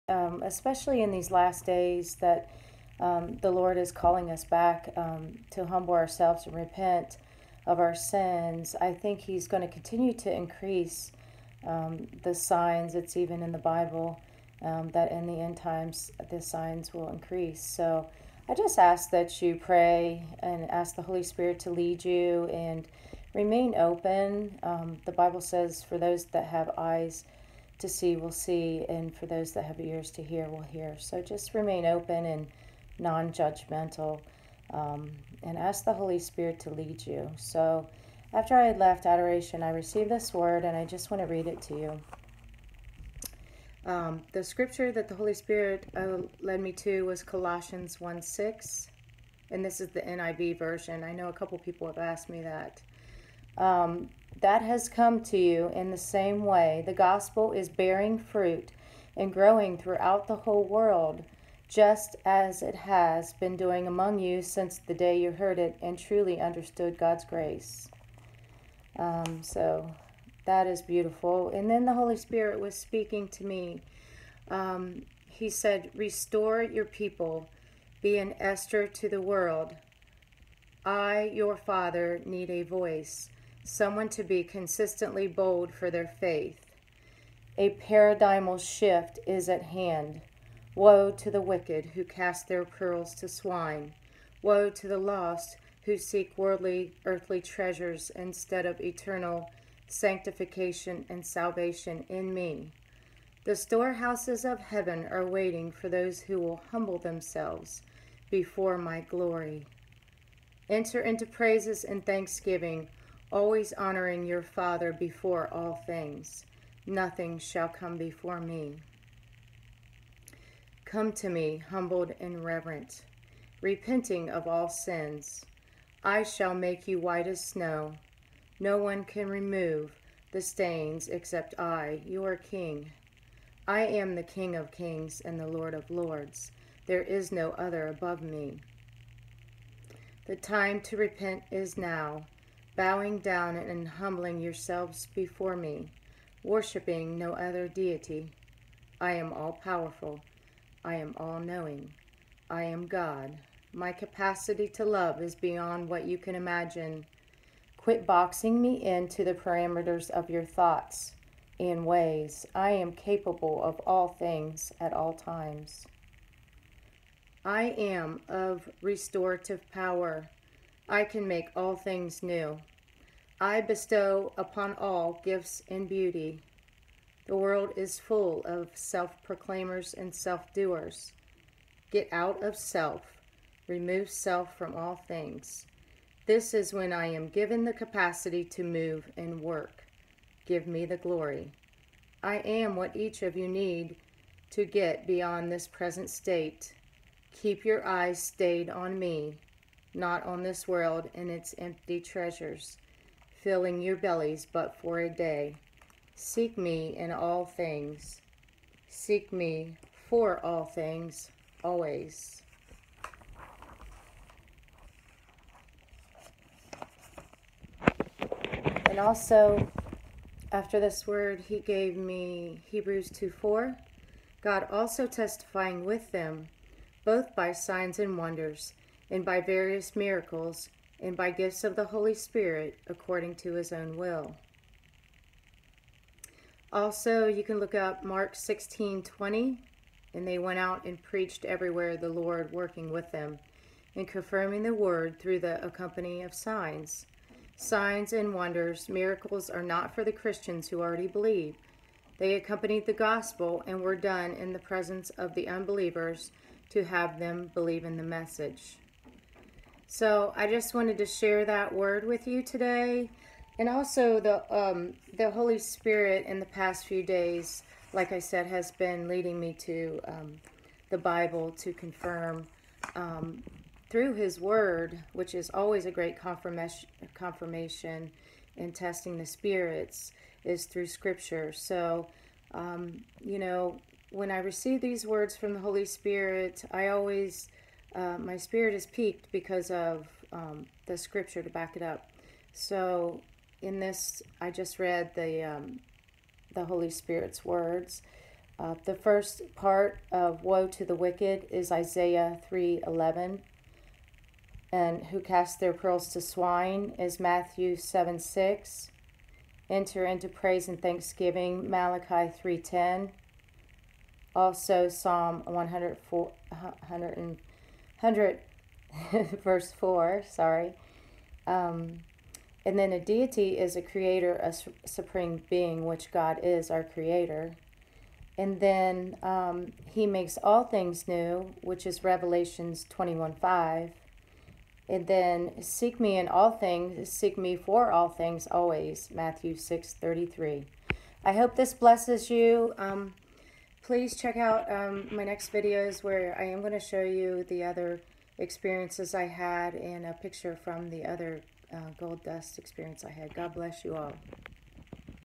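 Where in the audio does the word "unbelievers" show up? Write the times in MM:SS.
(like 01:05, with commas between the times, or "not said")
04:15.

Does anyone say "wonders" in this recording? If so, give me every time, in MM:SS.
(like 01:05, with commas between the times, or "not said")
03:48, 04:08.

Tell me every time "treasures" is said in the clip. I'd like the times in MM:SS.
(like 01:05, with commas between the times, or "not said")
01:37, 03:21.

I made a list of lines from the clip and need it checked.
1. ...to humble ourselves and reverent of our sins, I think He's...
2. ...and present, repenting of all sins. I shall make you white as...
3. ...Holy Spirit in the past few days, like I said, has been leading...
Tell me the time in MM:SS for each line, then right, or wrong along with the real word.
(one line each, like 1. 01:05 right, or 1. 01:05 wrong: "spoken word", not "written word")
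1. 00:05 wrong: "repent", not "reverent"
2. 02:02 wrong: "reverent", not "present"
3. 04:25 right.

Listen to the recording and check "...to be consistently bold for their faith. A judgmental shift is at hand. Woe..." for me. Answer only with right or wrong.
wrong.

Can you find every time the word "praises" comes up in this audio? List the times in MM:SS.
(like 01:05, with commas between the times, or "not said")
01:51, 05:10.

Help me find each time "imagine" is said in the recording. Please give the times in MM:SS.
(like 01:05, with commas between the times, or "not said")
02:36.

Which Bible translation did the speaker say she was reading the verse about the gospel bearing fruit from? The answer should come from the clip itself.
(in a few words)
NIV.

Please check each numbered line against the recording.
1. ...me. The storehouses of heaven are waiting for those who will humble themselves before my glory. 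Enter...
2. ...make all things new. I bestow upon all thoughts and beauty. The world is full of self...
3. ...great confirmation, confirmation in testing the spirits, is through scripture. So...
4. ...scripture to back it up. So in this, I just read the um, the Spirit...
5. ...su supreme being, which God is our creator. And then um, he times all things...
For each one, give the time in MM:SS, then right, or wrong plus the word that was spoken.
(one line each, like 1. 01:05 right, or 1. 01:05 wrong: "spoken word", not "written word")
1. 01:42 right
2. 02:51 wrong: "gifts", not "thoughts"
3. 04:35 right
4. 04:50 wrong: "Holy", not "Spirit"
5. 05:24 wrong: "makes", not "times".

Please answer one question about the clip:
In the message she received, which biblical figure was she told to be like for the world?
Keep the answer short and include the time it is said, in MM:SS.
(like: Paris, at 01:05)
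Esther, at 01:18.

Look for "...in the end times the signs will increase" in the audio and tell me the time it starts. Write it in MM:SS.
00:15.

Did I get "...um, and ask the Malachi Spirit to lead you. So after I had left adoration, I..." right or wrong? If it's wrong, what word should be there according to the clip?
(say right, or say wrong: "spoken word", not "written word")
wrong: "Holy", not "Malachi".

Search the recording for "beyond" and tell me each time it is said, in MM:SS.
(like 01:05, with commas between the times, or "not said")
02:35, 03:15.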